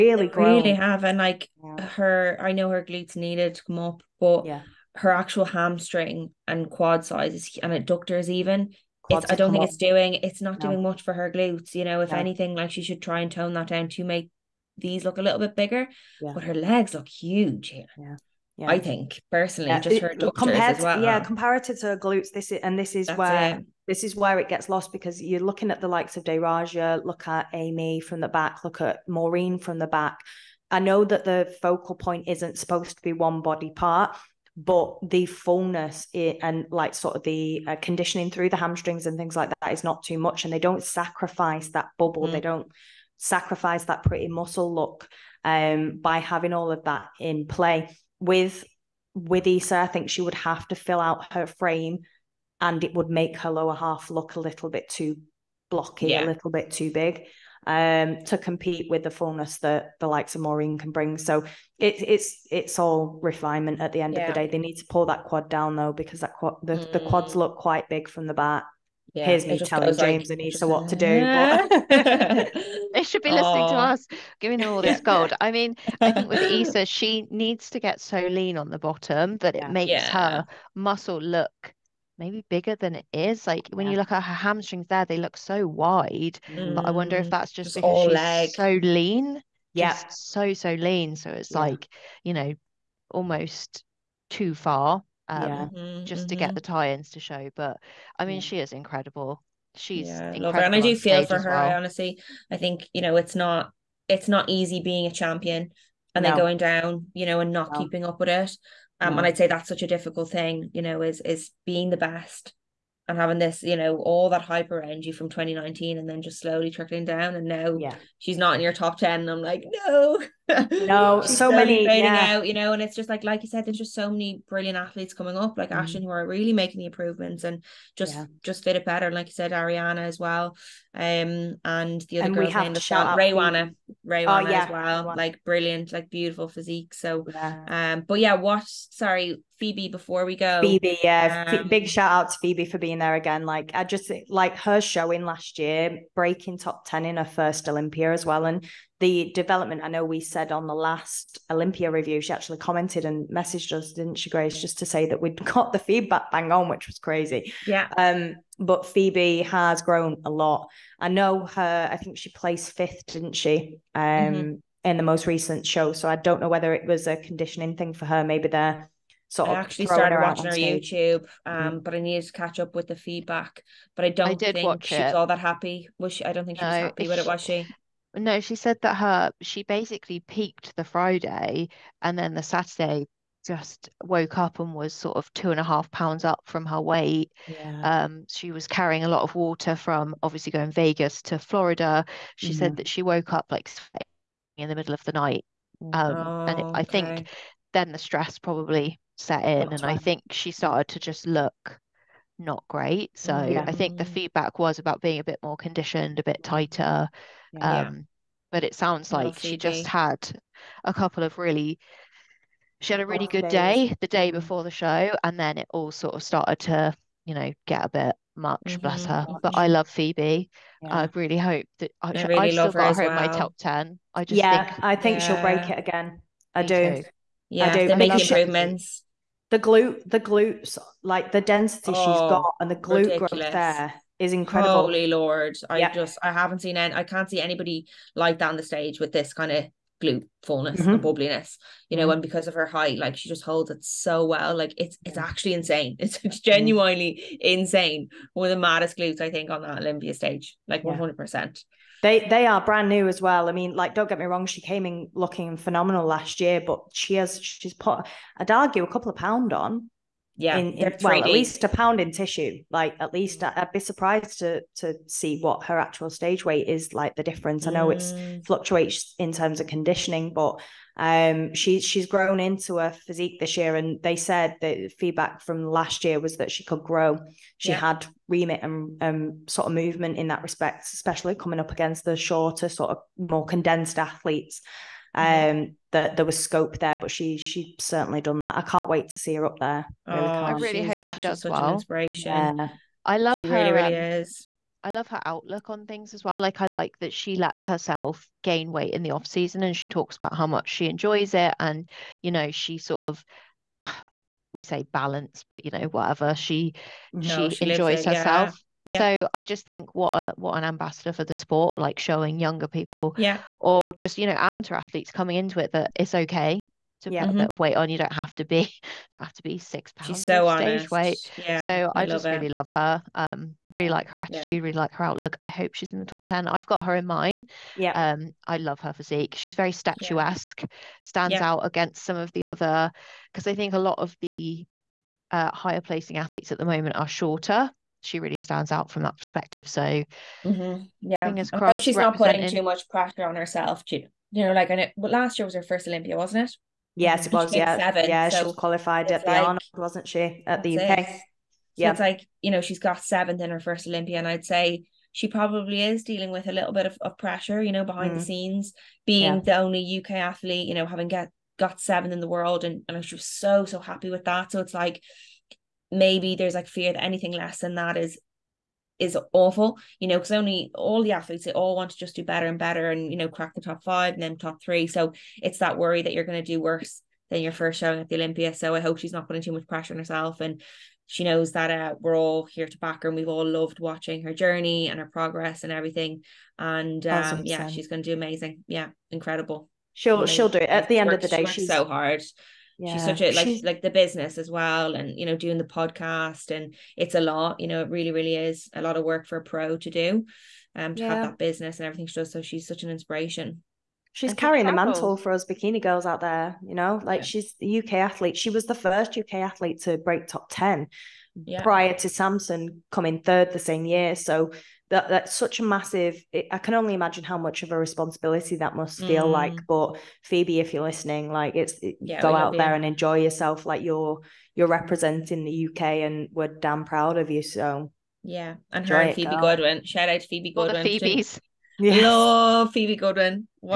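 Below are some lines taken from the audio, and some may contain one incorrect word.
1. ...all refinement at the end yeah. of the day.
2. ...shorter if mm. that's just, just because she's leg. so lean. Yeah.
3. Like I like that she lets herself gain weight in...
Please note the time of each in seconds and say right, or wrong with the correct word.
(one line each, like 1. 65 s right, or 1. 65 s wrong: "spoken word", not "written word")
1. 62 s right
2. 86 s wrong: "wonder", not "shorter"
3. 296 s right.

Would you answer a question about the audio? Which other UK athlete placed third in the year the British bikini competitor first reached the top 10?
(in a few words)
Samson.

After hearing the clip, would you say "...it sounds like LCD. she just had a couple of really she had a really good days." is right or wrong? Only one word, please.
right.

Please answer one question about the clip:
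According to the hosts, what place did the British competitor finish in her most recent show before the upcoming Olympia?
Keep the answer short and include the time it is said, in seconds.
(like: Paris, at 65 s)
fifth, at 162 s.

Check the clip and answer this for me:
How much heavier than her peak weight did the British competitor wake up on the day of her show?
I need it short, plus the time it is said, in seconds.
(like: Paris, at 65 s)
two and a half pounds, at 185 s.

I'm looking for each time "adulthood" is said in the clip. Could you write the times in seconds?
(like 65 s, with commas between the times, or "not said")
not said.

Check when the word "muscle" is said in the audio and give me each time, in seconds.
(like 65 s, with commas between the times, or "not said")
44 s, 80 s.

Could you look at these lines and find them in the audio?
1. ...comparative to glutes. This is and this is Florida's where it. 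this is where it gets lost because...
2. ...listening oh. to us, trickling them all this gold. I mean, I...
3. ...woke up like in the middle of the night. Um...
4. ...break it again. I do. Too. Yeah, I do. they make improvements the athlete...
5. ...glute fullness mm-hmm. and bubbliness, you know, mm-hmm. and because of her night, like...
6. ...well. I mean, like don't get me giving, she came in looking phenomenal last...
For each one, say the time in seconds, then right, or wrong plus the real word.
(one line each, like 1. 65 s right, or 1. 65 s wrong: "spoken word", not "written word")
1. 21 s wrong: "That", not "Florida"
2. 73 s wrong: "giving", not "trickling"
3. 193 s right
4. 225 s wrong: "glute", not "athlete"
5. 240 s wrong: "height", not "night"
6. 253 s wrong: "wrong", not "giving".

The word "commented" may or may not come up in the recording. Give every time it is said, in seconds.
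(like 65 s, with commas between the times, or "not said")
152 s.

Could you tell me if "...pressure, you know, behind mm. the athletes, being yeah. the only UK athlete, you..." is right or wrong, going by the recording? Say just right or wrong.
wrong.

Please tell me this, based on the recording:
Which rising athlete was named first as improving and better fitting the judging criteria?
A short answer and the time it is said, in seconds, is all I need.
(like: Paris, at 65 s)
Ashton, at 125 s.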